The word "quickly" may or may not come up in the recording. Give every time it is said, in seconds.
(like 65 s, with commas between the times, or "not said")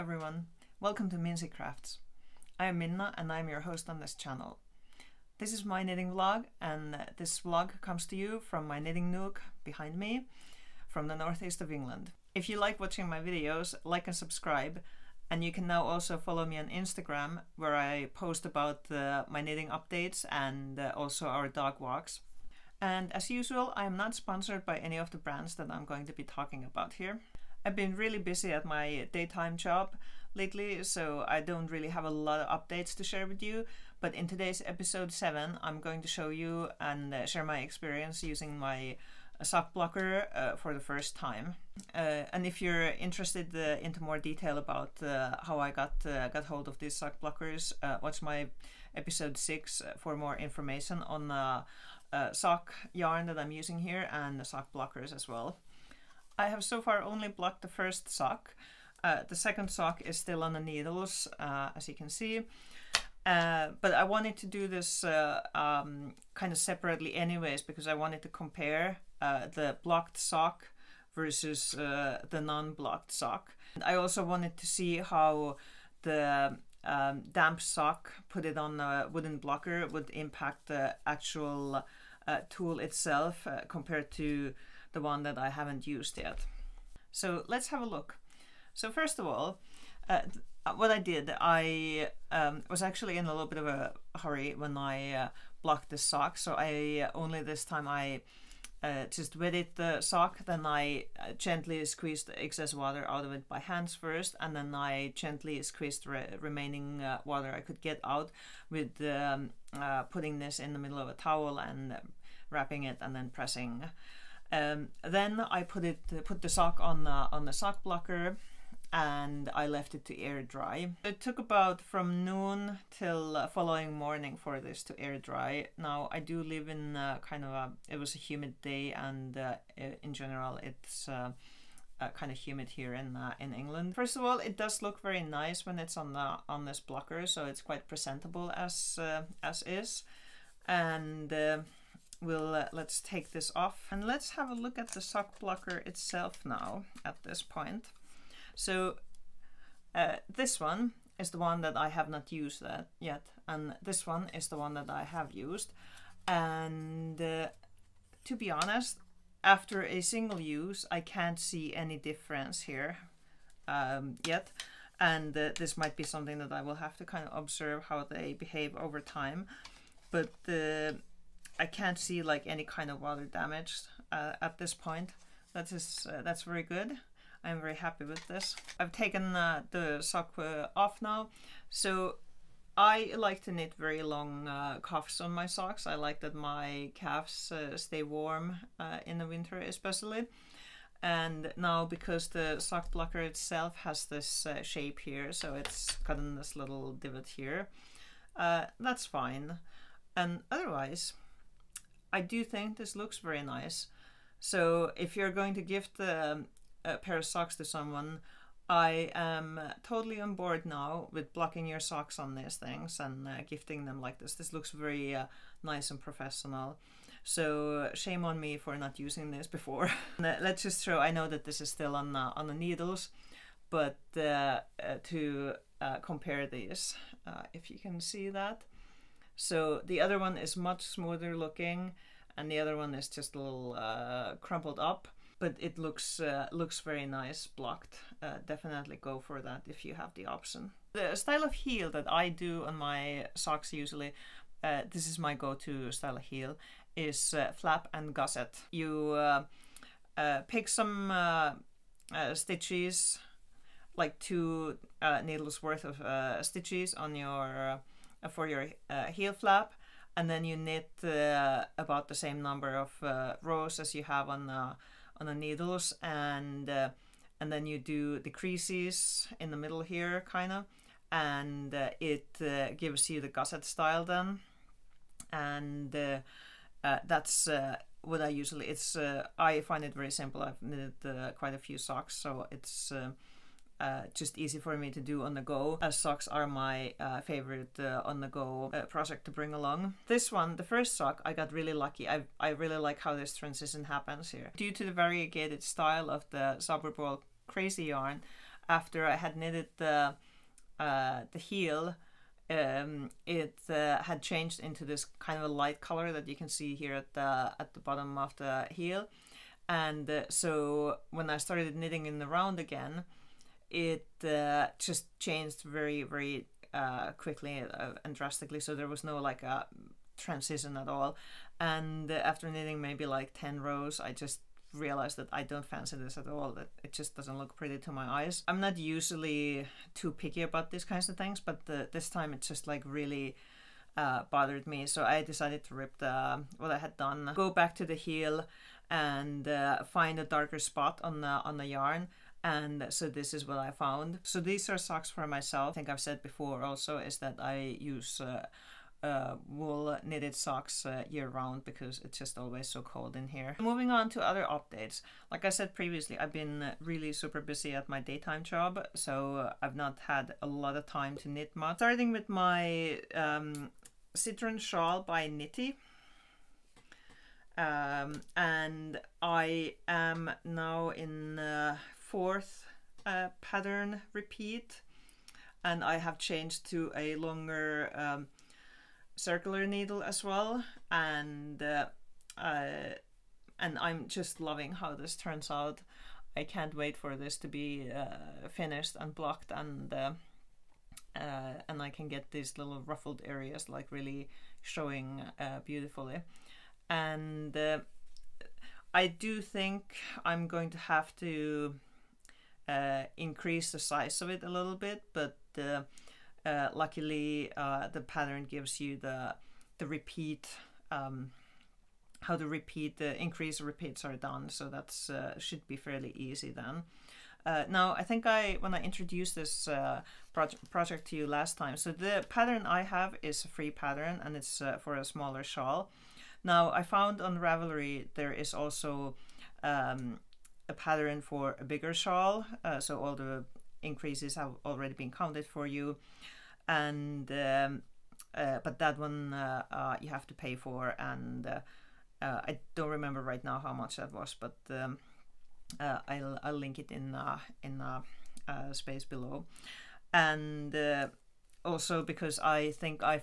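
317 s.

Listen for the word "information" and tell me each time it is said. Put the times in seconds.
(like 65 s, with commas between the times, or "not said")
50 s.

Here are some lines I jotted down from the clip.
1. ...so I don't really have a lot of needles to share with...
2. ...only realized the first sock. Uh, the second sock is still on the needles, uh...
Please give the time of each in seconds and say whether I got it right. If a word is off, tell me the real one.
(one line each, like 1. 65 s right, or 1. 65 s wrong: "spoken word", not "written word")
1. 30 s wrong: "updates", not "needles"
2. 57 s wrong: "blocked", not "realized".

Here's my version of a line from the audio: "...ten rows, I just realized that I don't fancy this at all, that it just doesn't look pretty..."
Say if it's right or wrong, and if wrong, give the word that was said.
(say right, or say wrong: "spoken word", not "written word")
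right.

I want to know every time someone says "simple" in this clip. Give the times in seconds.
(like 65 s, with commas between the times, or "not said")
280 s.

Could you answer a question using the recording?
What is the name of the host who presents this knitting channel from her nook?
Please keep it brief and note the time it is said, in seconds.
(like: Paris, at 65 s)
Minna, at 2 s.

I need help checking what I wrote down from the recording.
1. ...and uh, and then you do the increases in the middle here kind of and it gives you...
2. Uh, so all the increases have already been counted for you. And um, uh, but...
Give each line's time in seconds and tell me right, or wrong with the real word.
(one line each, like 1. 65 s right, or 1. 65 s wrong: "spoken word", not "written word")
1. 266 s wrong: "creases", not "increases"
2. 432 s right.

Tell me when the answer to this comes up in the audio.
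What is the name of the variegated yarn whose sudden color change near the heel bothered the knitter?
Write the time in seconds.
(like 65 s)
296 s.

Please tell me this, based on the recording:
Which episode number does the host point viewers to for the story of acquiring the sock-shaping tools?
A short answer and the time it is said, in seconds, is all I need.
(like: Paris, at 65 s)
6, at 48 s.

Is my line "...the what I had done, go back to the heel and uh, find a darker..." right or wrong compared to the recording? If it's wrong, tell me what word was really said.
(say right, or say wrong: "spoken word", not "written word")
right.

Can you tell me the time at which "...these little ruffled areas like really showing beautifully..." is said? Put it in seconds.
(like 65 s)
392 s.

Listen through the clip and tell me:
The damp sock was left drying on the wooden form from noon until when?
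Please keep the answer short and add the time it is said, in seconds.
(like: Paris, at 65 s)
following morning, at 123 s.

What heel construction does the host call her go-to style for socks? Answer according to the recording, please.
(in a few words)
flap and gusset.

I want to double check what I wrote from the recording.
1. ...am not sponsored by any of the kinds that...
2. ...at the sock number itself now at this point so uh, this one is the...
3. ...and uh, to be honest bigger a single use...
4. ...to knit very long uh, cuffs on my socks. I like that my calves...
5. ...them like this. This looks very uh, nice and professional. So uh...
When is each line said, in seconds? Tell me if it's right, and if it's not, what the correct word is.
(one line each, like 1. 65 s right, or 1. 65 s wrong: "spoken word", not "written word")
1. 23 s wrong: "brands", not "kinds"
2. 144 s wrong: "blocker", not "number"
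3. 156 s wrong: "after", not "bigger"
4. 183 s right
5. 213 s right.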